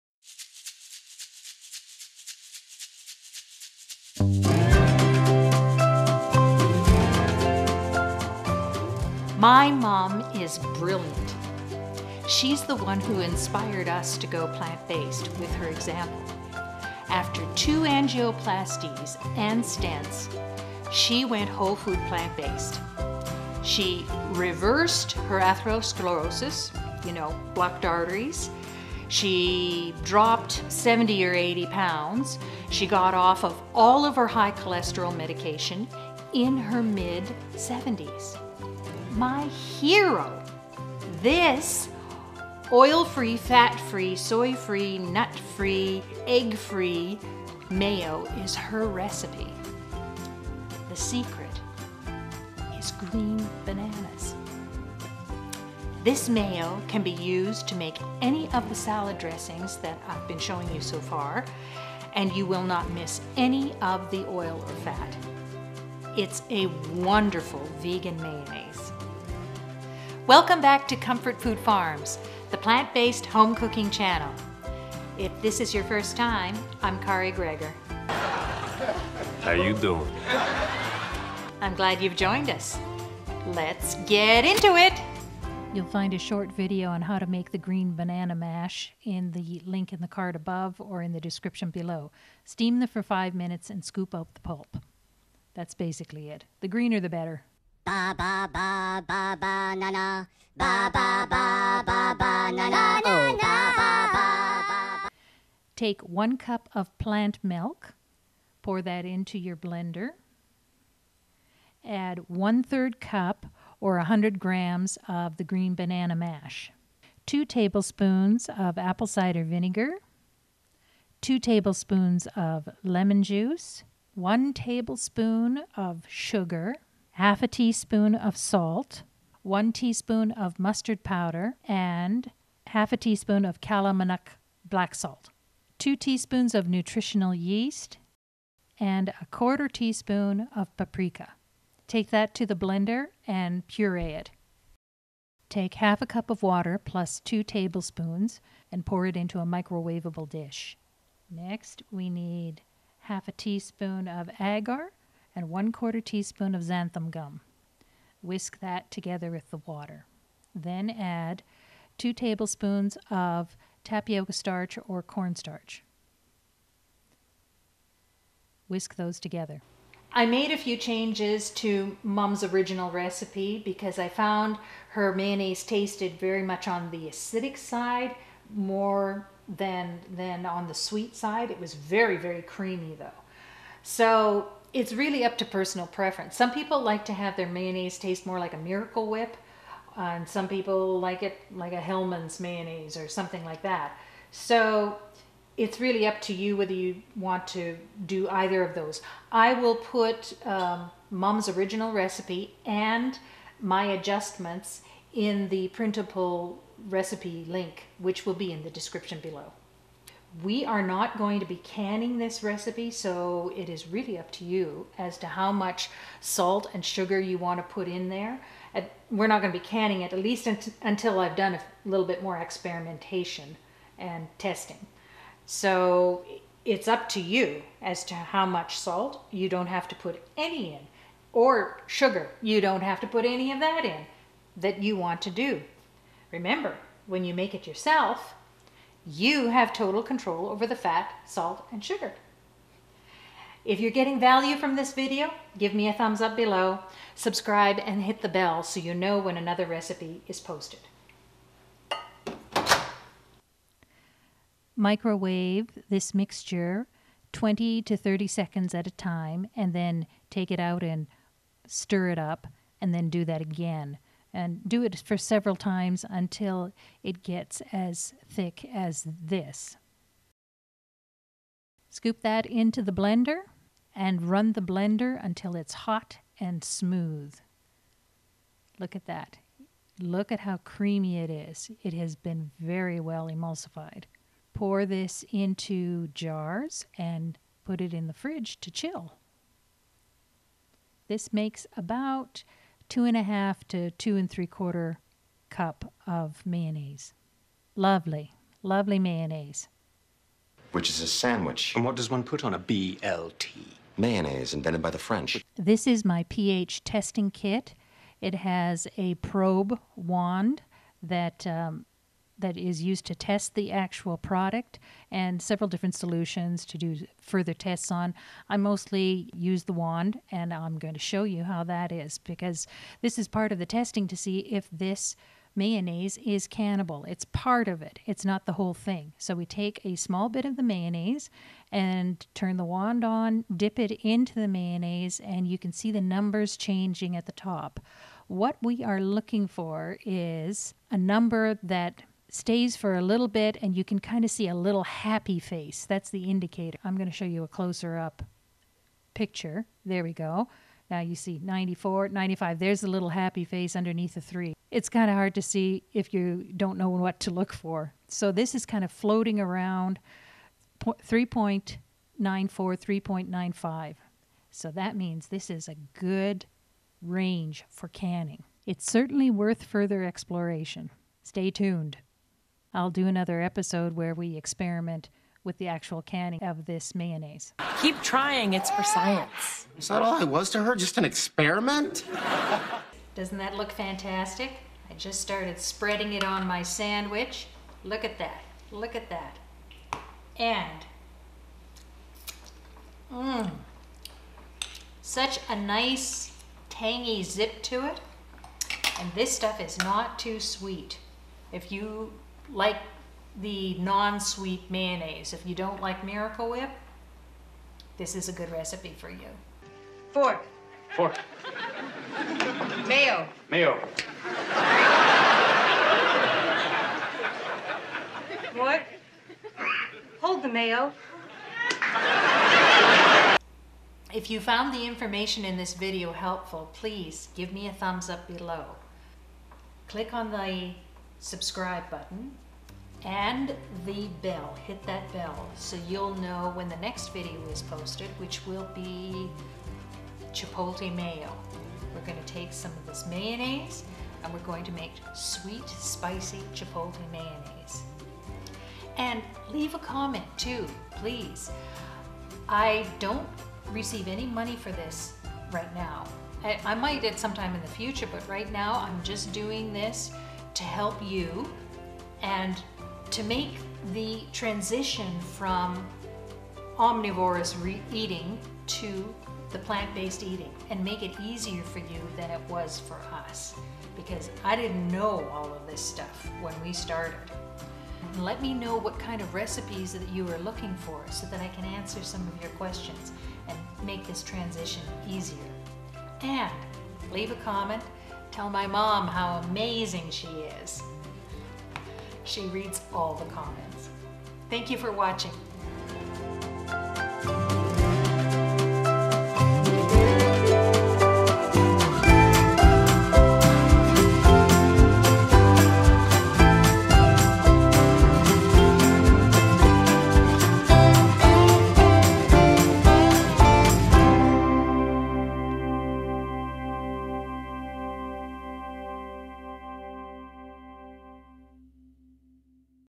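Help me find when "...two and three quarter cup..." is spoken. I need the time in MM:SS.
04:53.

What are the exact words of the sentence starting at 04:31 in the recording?
Scoop that into the blender and run the blender until it's hot and smooth.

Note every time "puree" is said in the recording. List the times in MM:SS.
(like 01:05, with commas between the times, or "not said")
02:23.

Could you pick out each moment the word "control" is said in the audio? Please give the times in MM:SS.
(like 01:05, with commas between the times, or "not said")
04:00.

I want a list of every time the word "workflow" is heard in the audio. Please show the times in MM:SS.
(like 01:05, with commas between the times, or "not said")
not said.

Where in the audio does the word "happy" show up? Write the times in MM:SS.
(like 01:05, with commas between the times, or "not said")
05:44, 05:53.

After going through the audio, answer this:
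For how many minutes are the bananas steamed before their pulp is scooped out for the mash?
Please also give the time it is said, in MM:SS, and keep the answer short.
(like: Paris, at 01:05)
5, at 01:33.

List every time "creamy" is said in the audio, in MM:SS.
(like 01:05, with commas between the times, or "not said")
03:02, 04:40.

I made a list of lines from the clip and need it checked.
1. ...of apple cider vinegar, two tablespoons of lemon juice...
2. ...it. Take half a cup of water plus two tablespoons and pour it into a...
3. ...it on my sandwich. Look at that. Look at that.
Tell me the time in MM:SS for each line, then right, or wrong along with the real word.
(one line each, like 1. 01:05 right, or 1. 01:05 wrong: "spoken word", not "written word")
1. 01:58 right
2. 02:24 right
3. 06:26 right.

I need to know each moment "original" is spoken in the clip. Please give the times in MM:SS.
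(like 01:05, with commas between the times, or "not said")
02:52, 03:21.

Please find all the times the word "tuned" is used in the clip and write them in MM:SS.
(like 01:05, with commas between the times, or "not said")
06:11.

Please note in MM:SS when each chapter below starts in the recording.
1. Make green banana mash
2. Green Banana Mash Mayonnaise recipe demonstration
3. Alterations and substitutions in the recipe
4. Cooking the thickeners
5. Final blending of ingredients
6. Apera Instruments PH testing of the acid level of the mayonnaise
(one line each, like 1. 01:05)
1. 01:26
2. 01:38
3. 02:49
4. 04:14
5. 04:33
6. 05:05.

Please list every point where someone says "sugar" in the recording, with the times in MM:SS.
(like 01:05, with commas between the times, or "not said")
02:06, 03:36, 03:51, 04:01.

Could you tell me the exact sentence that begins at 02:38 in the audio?
Whisk that together with the water.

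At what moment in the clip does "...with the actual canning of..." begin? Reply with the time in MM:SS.
06:15.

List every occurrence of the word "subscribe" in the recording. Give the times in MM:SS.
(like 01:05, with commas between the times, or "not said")
04:07, 07:11.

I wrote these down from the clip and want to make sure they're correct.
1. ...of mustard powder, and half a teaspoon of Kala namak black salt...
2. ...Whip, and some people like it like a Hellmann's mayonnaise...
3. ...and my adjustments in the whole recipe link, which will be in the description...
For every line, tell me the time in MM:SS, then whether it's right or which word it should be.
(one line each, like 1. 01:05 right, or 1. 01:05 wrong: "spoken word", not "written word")
1. 02:10 right
2. 03:09 right
3. 03:22 wrong: "printable", not "whole".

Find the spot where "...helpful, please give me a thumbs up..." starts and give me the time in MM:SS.
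07:06.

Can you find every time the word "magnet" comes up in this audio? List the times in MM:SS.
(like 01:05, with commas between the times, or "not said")
not said.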